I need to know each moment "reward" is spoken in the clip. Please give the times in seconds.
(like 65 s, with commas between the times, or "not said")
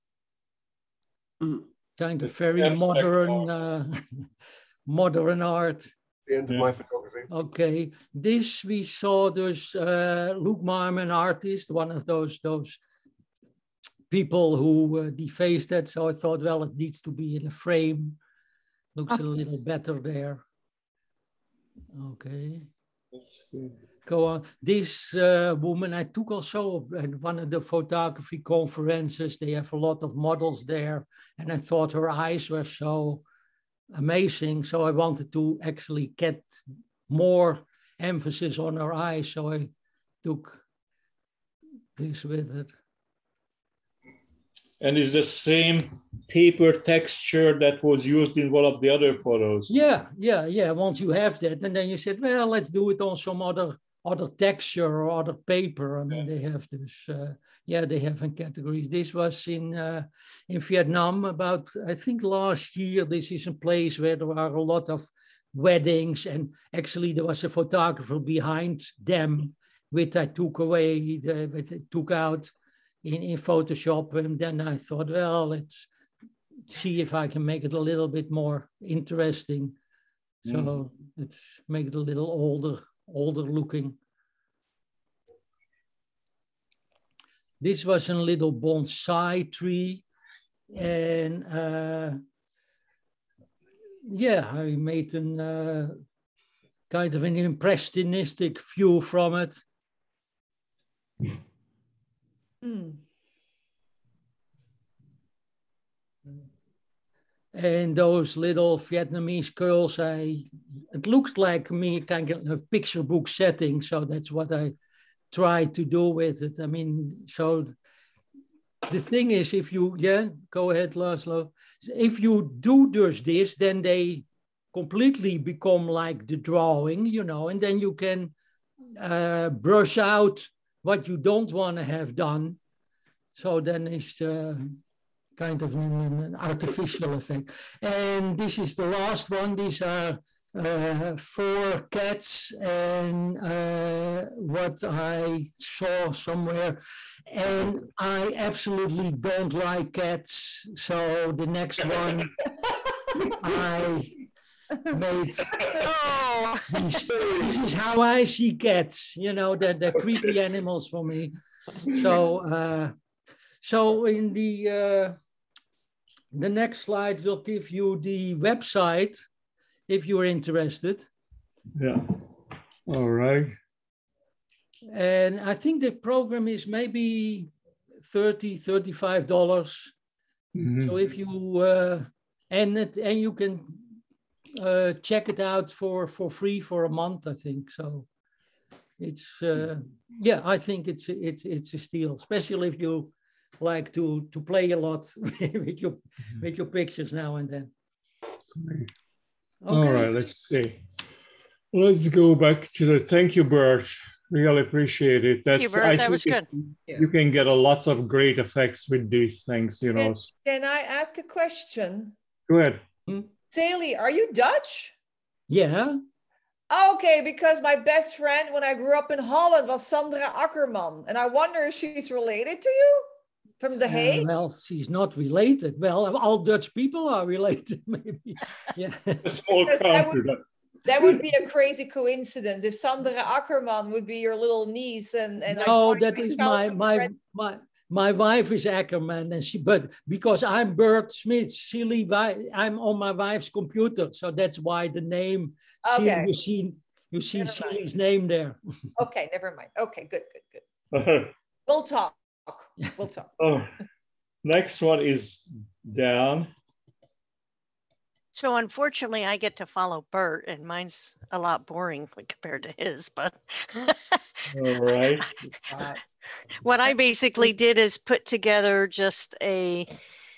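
not said.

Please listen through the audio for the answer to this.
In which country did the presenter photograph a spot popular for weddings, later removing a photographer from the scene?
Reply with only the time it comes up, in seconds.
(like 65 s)
60 s.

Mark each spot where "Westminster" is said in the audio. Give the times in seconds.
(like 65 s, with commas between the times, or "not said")
not said.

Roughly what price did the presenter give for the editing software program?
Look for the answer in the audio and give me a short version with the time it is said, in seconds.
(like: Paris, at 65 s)
$35, at 178 s.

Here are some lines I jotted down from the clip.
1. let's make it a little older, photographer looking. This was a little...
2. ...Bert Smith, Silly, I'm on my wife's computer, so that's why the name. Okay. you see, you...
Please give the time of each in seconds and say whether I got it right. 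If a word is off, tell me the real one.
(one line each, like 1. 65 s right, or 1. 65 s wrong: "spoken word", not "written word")
1. 81 s wrong: "older", not "photographer"
2. 240 s right.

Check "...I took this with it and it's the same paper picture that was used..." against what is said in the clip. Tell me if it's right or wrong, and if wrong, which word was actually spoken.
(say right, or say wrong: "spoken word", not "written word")
wrong: "texture", not "picture".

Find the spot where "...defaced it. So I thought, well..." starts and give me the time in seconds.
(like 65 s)
15 s.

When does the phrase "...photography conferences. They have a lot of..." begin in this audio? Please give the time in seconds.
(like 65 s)
27 s.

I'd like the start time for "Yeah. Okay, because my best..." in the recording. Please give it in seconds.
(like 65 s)
215 s.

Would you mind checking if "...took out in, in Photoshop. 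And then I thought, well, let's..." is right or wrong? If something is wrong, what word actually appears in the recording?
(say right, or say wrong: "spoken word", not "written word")
right.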